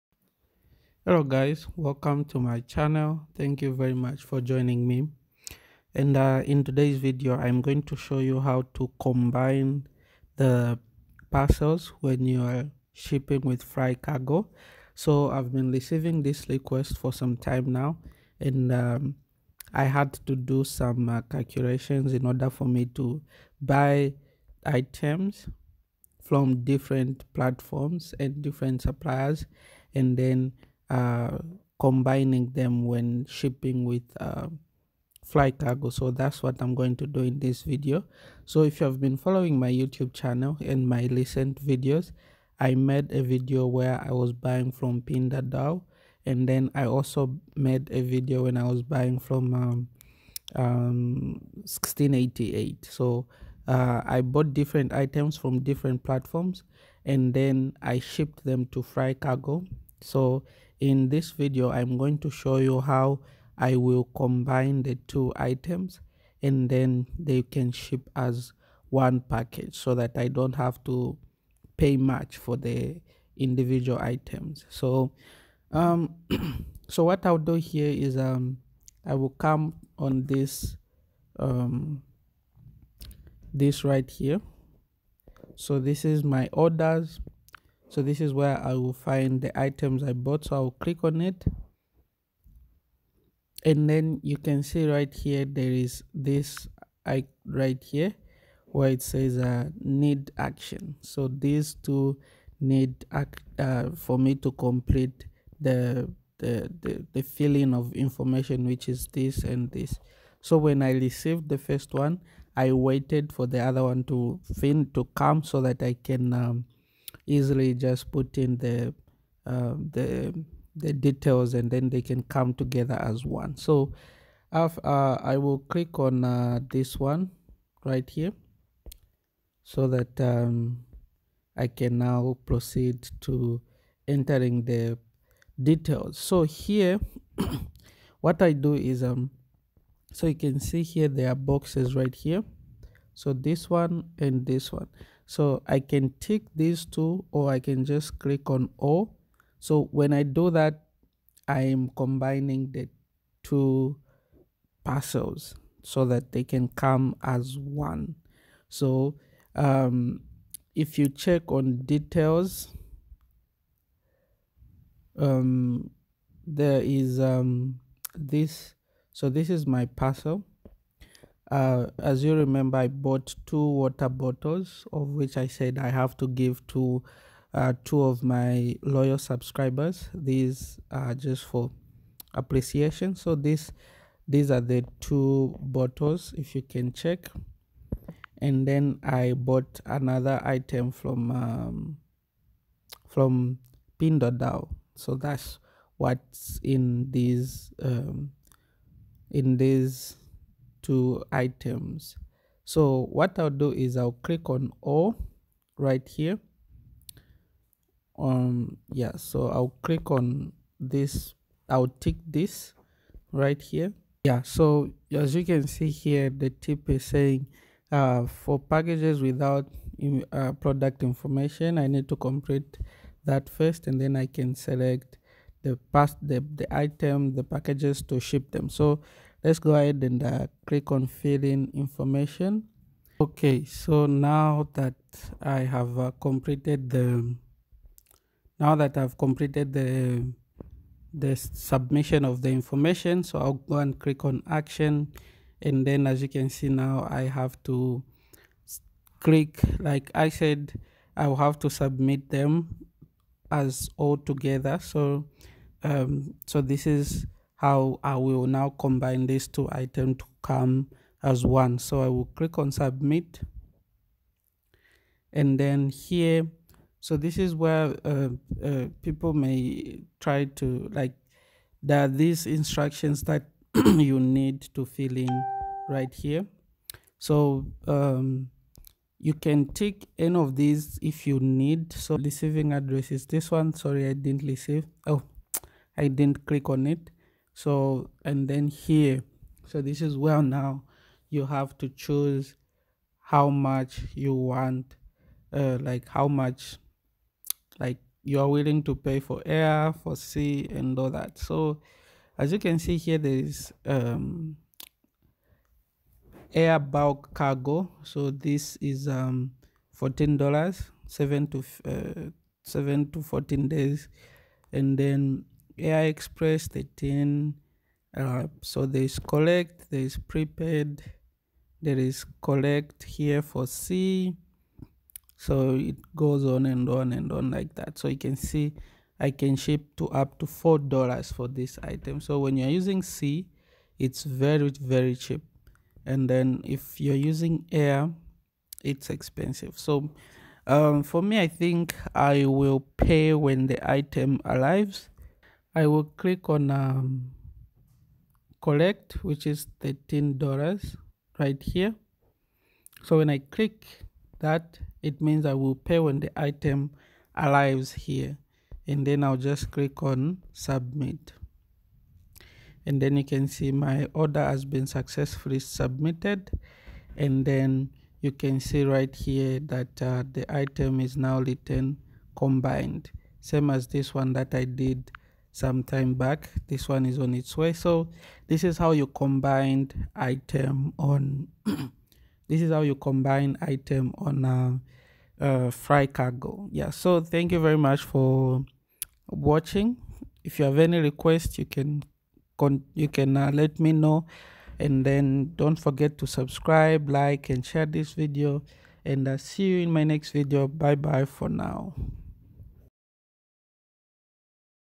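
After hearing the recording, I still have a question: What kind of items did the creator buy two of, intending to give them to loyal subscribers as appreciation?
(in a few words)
water bottles.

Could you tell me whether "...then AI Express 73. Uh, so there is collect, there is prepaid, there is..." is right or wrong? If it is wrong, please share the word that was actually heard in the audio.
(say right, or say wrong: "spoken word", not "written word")
wrong: "13", not "73".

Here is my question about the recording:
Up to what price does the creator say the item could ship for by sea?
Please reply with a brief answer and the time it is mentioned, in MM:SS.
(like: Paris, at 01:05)
$4, at 05:30.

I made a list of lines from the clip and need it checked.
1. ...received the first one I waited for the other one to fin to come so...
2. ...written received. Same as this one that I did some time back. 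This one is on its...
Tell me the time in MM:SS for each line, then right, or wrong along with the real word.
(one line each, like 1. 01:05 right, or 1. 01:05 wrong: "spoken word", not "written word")
1. 01:50 right
2. 06:11 wrong: "combined", not "received".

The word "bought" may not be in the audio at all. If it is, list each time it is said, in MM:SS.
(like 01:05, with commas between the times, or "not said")
00:54, 01:30, 02:52, 03:09.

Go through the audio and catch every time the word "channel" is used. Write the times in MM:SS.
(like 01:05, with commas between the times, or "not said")
00:02, 00:40.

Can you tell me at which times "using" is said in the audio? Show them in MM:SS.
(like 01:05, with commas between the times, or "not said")
05:32, 05:37.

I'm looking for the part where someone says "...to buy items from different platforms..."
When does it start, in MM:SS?
00:22.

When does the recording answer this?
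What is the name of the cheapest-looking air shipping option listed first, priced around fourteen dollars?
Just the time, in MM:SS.
05:06.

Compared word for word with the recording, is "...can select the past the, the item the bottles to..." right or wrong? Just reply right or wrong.
wrong.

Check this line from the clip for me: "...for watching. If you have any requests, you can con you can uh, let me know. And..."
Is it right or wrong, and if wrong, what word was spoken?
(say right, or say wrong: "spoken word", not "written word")
right.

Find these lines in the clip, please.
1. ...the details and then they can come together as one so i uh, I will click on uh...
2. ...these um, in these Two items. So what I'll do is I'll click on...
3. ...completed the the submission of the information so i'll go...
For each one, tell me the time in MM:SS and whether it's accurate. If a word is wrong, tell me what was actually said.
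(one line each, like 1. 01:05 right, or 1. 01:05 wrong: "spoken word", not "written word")
1. 02:00 right
2. 03:17 right
3. 03:59 right.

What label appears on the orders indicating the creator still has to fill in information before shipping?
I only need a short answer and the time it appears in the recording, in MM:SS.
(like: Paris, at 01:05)
need action, at 01:39.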